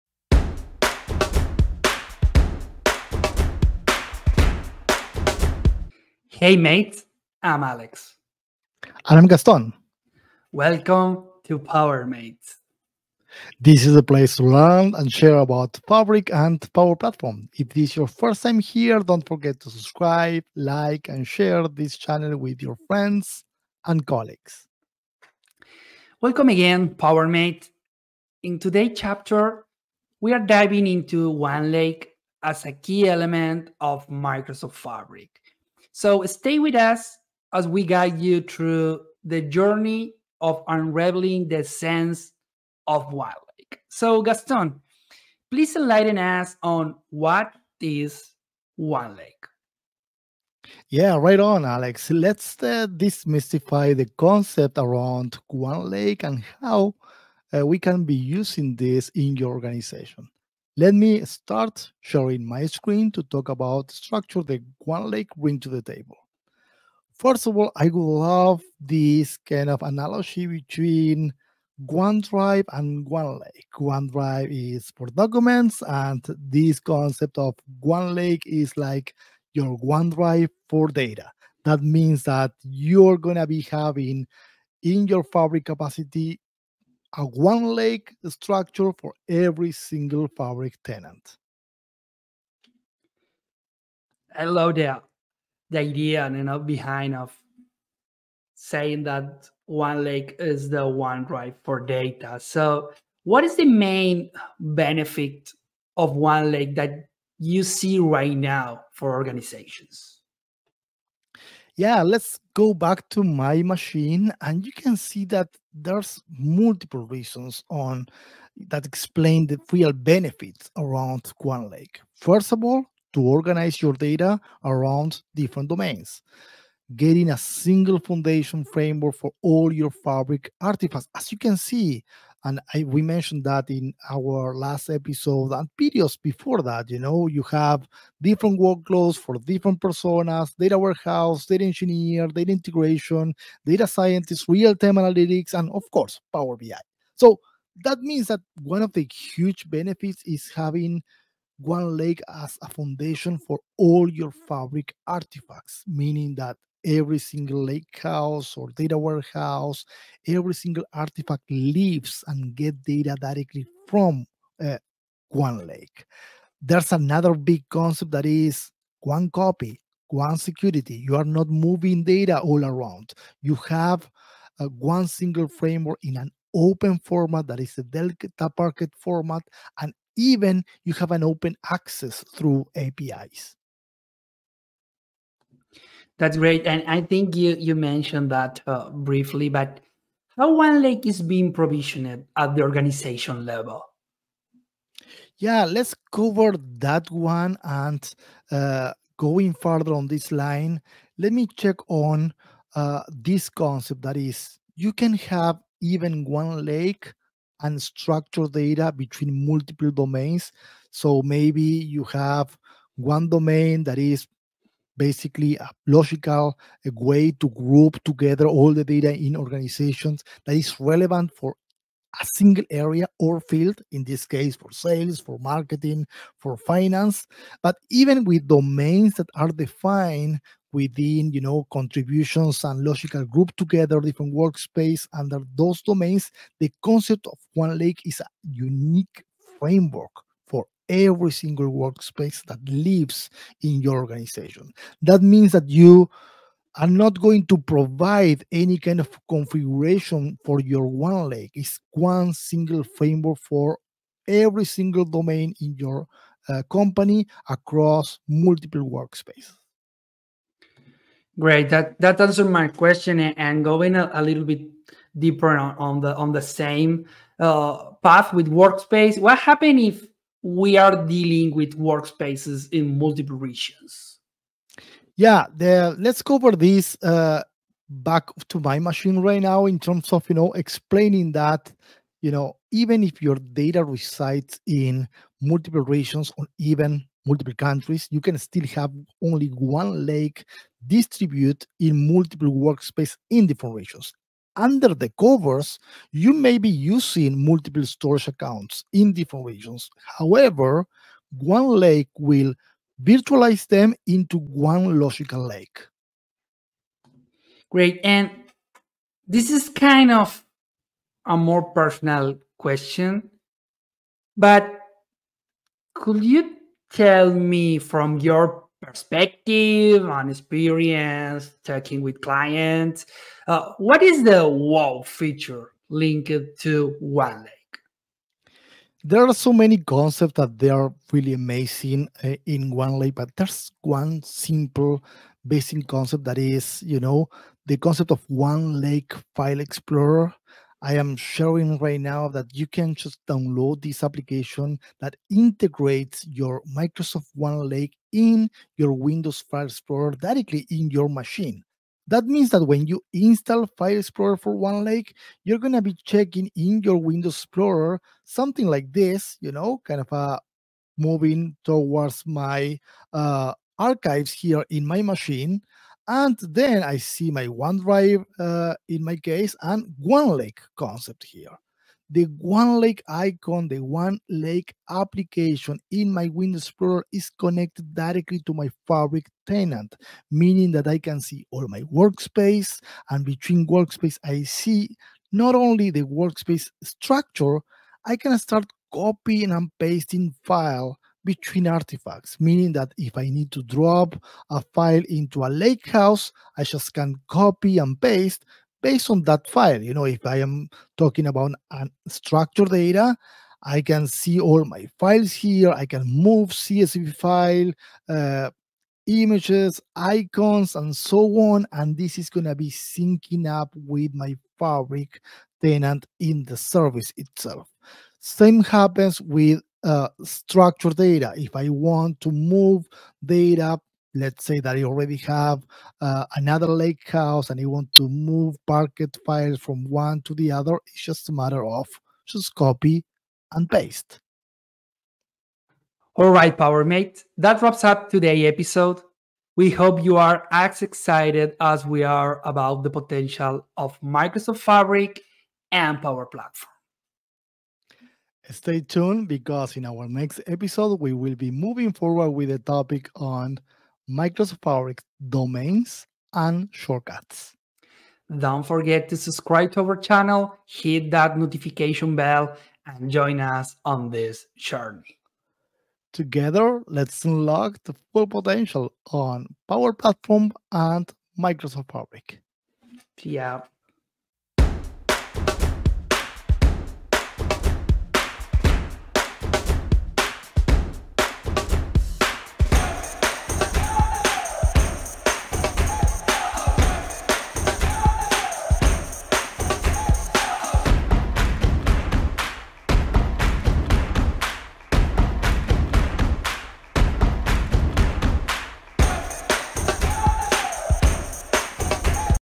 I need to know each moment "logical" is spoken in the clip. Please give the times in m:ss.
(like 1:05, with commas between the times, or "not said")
3:35, 3:52, 5:04.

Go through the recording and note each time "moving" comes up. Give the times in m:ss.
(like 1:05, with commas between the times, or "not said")
2:51, 6:00, 7:31.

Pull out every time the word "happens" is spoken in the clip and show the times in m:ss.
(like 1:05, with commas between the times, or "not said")
4:29, 6:58.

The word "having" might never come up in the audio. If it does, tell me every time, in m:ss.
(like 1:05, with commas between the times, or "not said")
1:23, 2:30.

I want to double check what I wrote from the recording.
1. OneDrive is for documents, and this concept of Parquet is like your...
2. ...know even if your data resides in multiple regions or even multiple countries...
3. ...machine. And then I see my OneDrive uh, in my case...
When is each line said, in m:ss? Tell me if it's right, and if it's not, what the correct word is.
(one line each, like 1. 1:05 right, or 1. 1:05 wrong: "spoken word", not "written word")
1. 1:13 wrong: "OneLake", not "Parquet"
2. 4:42 right
3. 6:05 right.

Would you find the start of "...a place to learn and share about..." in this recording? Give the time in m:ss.
0:13.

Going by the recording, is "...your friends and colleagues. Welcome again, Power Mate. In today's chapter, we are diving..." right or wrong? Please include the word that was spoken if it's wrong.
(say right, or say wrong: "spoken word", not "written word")
right.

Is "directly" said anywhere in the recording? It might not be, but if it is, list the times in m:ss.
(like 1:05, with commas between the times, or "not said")
2:43, 5:50, 6:17.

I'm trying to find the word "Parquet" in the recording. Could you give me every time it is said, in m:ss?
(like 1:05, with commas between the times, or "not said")
2:58, 7:08.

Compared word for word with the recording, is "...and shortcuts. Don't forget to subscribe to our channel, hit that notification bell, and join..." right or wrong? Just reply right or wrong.
right.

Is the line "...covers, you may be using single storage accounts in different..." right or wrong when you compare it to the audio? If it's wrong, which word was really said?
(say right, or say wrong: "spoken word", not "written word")
wrong: "multiple", not "single".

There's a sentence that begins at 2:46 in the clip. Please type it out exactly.
There's another big concept that is one copy, one security.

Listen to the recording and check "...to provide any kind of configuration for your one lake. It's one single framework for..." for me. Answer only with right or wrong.
right.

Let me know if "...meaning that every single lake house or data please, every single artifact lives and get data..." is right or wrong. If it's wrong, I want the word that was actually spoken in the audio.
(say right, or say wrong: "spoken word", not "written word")
wrong: "warehouse", not "please".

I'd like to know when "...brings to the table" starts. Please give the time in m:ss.
1:05.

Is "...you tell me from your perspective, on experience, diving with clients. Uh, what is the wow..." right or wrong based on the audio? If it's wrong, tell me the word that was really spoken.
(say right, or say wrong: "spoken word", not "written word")
wrong: "talking", not "diving".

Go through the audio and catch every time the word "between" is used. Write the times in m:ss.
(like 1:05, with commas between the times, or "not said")
1:10, 3:28, 6:23, 6:31.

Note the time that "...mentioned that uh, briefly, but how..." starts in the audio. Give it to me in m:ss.
3:07.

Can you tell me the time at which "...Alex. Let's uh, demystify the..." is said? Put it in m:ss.
0:51.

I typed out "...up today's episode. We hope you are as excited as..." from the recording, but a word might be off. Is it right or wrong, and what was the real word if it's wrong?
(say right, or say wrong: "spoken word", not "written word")
right.